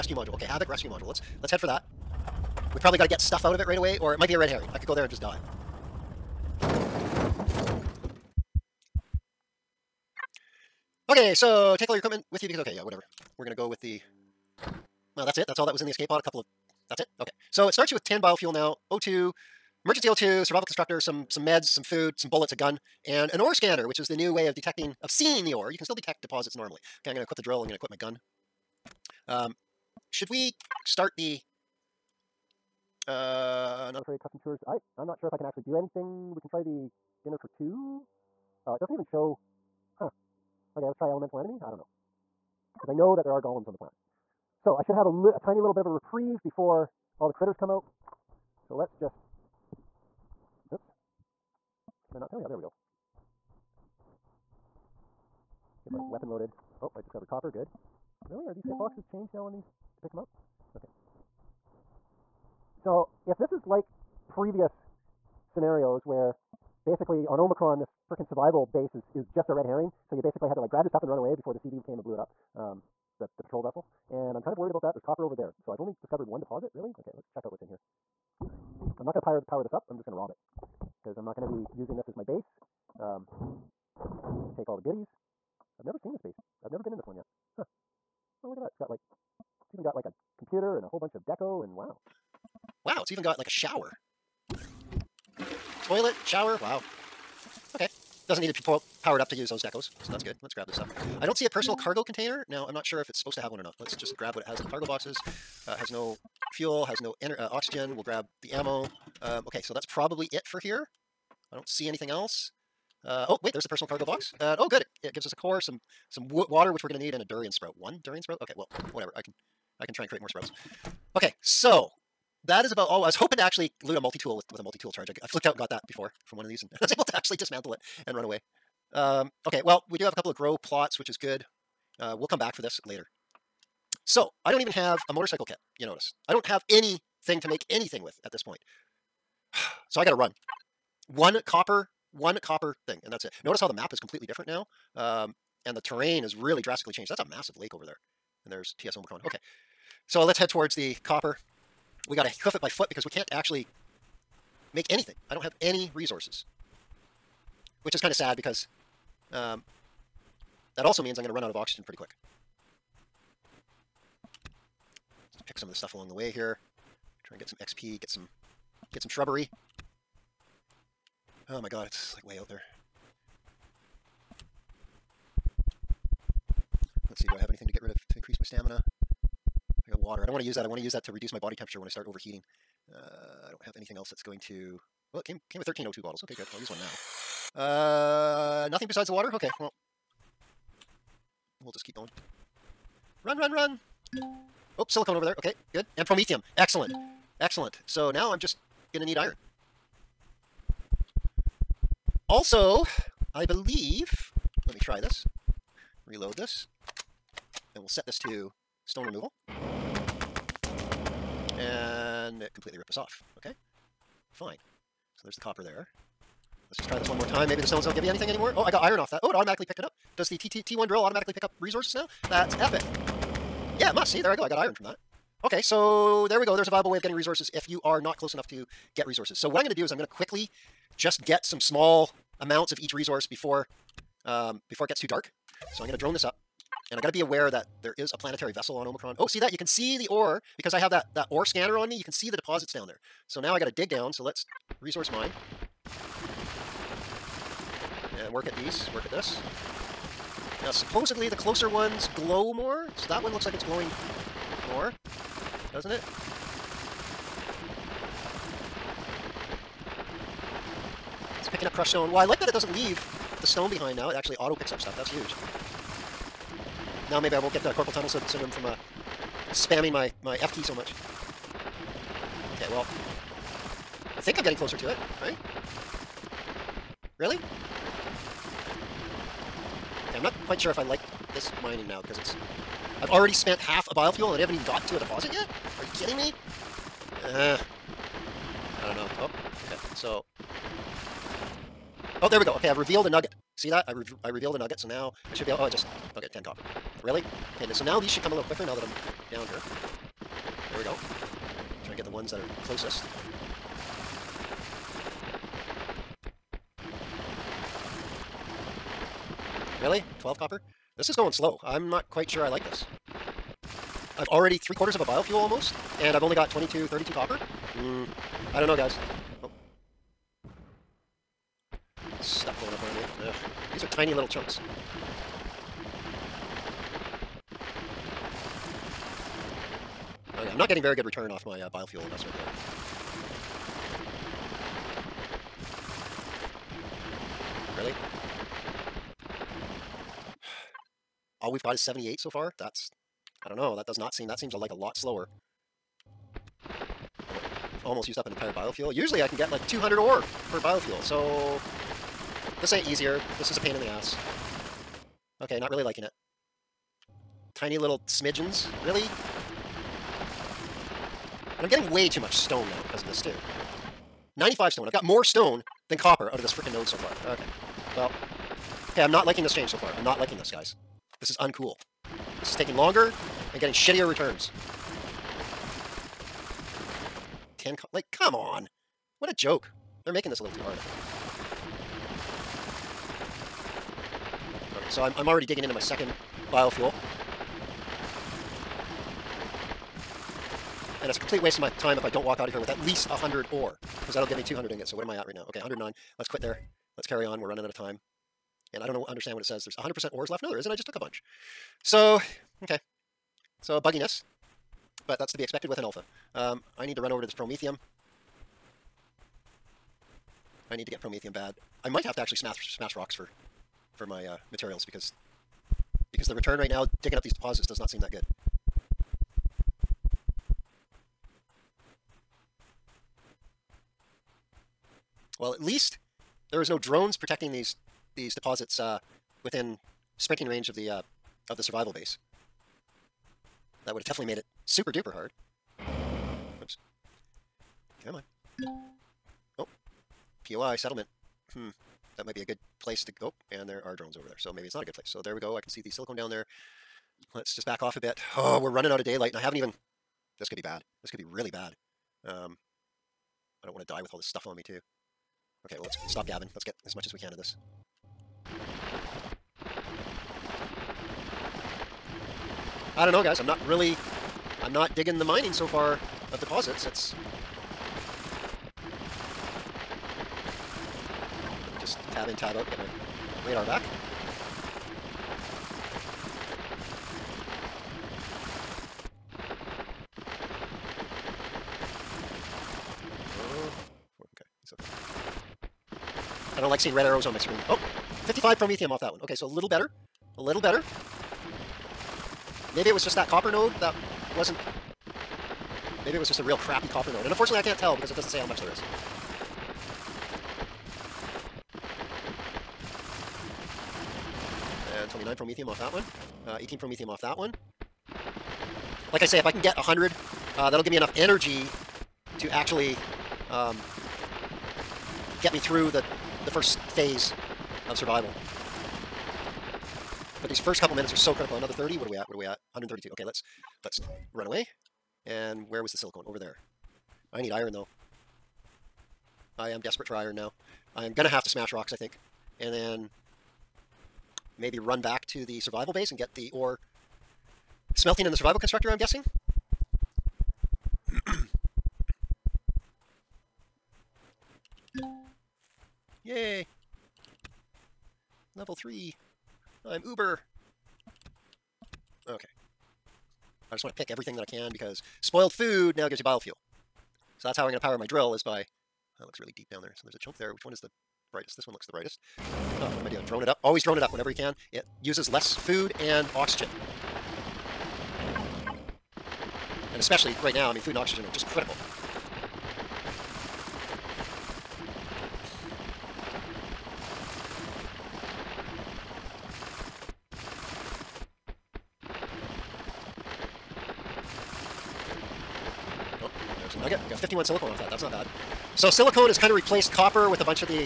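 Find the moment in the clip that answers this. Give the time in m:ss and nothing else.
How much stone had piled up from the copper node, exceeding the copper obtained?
6:04.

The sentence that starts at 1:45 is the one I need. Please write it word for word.
Uh, has no fuel, has no uh, oxygen.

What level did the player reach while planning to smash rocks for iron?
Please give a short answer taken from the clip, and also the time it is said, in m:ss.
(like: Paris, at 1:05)
Level 3, at 9:08.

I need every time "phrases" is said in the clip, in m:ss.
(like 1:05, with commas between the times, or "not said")
not said.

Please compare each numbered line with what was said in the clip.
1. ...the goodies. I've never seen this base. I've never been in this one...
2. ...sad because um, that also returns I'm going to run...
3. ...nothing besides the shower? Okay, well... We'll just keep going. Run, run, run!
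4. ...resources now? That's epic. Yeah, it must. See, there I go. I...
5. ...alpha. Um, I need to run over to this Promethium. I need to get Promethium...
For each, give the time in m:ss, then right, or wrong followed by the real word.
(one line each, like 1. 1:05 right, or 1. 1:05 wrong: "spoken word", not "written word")
1. 1:24 right
2. 2:38 wrong: "means", not "returns"
3. 3:08 wrong: "water", not "shower"
4. 3:41 right
5. 6:45 right.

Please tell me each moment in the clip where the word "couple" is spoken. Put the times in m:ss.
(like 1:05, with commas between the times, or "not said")
0:16, 2:10, 8:40.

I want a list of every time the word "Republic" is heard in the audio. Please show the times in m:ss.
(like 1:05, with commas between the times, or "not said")
not said.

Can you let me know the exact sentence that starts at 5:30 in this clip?
I'm not getting very good return off my uh, biofuel investment yet.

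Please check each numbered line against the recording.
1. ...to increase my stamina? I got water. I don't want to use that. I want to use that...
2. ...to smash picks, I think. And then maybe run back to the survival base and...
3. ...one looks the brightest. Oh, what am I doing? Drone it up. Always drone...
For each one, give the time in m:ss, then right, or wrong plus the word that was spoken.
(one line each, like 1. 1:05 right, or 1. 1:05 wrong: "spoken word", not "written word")
1. 2:58 right
2. 8:51 wrong: "rocks", not "picks"
3. 9:21 right.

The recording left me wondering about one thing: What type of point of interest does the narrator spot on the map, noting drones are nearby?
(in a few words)
Settlement.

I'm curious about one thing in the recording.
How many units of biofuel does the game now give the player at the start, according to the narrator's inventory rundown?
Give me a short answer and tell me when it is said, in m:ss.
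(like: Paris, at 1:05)
10, at 0:18.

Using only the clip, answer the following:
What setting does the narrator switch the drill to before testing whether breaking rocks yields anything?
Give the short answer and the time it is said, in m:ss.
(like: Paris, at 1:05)
Stone removal, at 3:28.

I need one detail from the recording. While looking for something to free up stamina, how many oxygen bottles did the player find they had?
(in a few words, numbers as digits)
13.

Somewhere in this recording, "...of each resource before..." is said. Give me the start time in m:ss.
3:52.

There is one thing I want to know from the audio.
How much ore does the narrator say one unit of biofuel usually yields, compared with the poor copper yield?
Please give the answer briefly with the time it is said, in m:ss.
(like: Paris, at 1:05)
200, at 5:49.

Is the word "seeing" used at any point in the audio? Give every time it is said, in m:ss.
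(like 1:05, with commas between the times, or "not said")
0:25, 8:06.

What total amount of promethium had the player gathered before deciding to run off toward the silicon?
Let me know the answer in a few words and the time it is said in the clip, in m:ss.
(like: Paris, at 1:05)
132, at 8:42.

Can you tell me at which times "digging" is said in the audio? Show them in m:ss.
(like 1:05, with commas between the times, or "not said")
6:25, 6:57, 7:44.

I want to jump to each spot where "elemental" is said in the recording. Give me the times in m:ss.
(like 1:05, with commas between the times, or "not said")
0:41.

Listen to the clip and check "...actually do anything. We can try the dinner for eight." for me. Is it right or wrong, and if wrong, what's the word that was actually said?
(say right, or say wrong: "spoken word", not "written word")
wrong: "two", not "eight".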